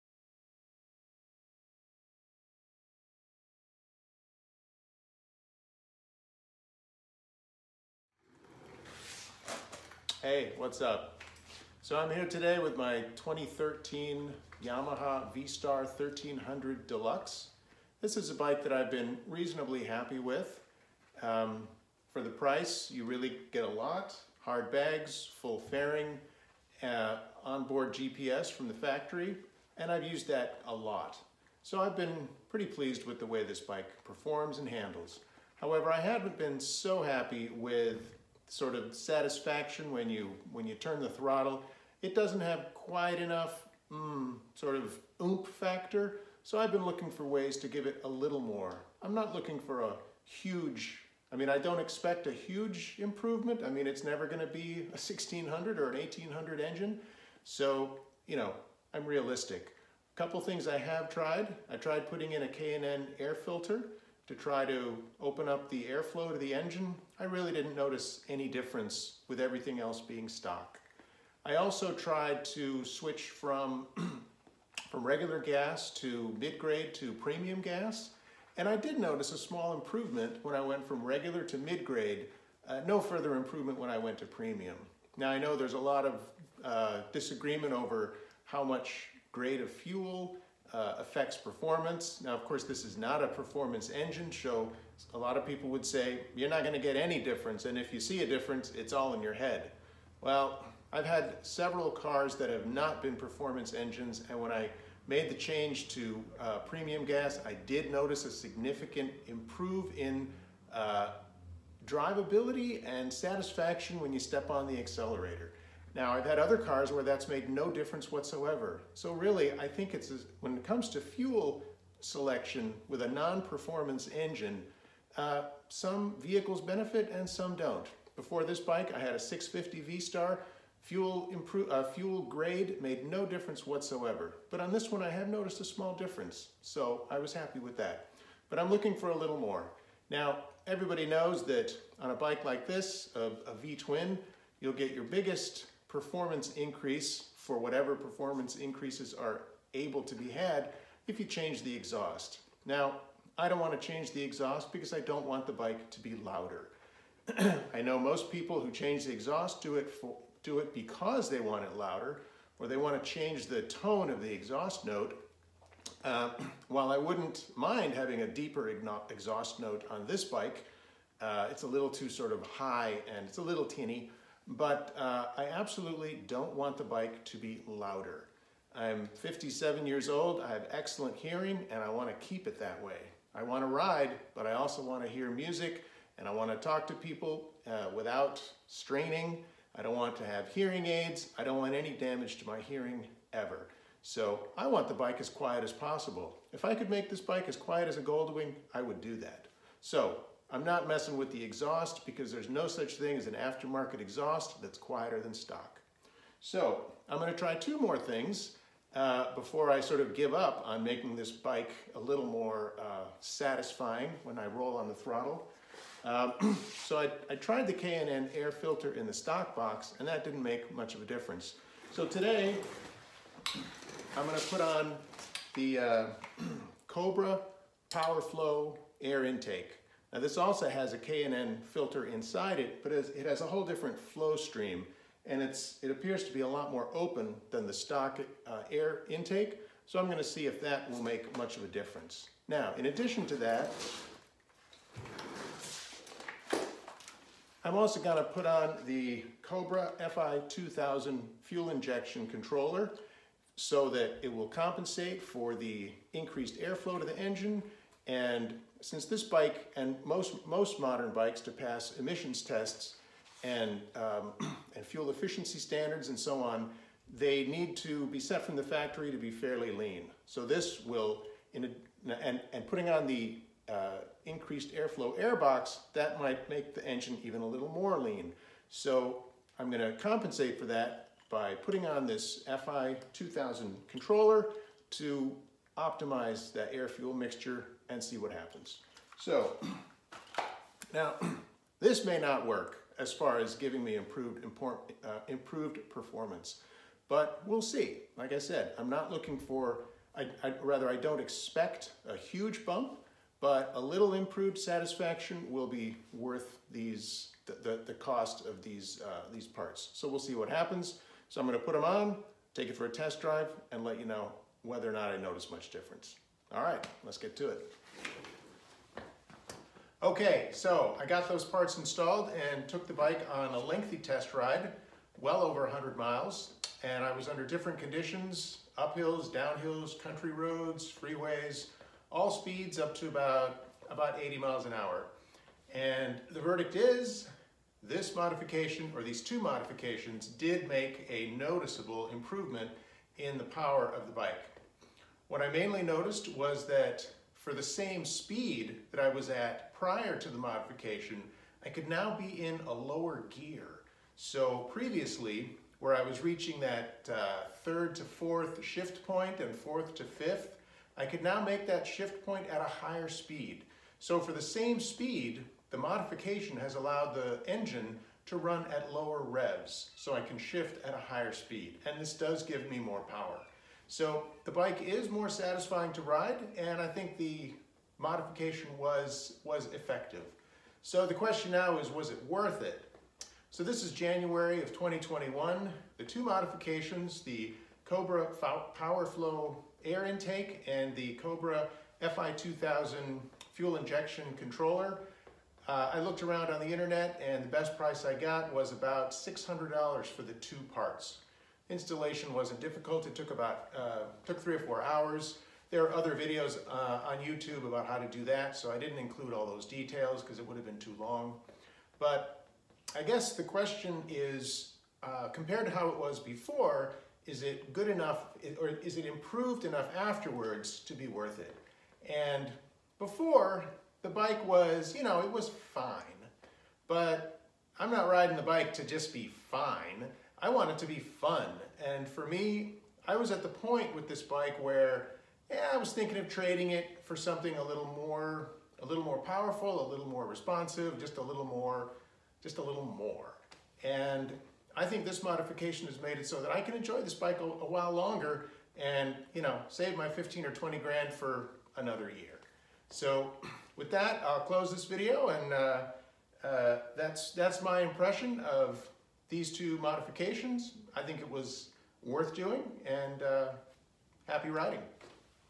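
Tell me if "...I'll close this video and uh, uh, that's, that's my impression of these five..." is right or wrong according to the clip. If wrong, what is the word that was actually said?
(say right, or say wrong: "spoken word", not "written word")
wrong: "two", not "five".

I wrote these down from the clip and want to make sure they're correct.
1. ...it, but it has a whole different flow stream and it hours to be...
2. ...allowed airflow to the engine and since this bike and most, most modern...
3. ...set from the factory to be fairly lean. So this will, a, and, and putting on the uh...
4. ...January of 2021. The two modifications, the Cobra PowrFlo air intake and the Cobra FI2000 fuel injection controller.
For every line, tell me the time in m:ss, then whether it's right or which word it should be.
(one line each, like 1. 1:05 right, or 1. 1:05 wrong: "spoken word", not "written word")
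1. 3:52 wrong: "appears", not "hours"
2. 4:16 wrong: "increased", not "allowed"
3. 4:28 right
4. 6:23 right.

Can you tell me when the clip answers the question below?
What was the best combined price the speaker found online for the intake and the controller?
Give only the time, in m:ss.
6:39.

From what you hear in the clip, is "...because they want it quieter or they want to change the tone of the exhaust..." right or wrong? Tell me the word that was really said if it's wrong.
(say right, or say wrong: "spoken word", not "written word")
wrong: "louder", not "quieter".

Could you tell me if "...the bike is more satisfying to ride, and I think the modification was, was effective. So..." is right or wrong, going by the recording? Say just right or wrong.
right.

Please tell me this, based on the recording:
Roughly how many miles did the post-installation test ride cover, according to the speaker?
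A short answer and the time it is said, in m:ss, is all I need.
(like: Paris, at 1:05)
over 100 miles, at 5:25.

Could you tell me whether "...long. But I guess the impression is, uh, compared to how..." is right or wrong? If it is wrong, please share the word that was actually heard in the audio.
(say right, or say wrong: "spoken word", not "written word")
wrong: "question", not "impression".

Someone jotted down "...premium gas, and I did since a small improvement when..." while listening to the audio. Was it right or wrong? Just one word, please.
wrong.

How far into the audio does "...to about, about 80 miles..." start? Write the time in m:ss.
5:32.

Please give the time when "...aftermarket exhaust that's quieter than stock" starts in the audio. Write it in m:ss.
3:23.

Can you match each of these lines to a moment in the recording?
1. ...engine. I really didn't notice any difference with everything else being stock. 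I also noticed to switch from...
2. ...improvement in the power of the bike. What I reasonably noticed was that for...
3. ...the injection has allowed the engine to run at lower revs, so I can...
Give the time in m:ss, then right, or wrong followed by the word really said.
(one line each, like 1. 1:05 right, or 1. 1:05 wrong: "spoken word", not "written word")
1. 1:06 wrong: "tried", not "noticed"
2. 5:42 wrong: "mainly", not "reasonably"
3. 6:05 wrong: "modification", not "injection".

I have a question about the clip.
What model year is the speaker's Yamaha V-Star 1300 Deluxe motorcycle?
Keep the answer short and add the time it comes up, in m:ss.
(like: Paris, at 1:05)
2013, at 0:13.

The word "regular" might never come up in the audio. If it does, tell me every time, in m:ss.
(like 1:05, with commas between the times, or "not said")
1:15, 1:21.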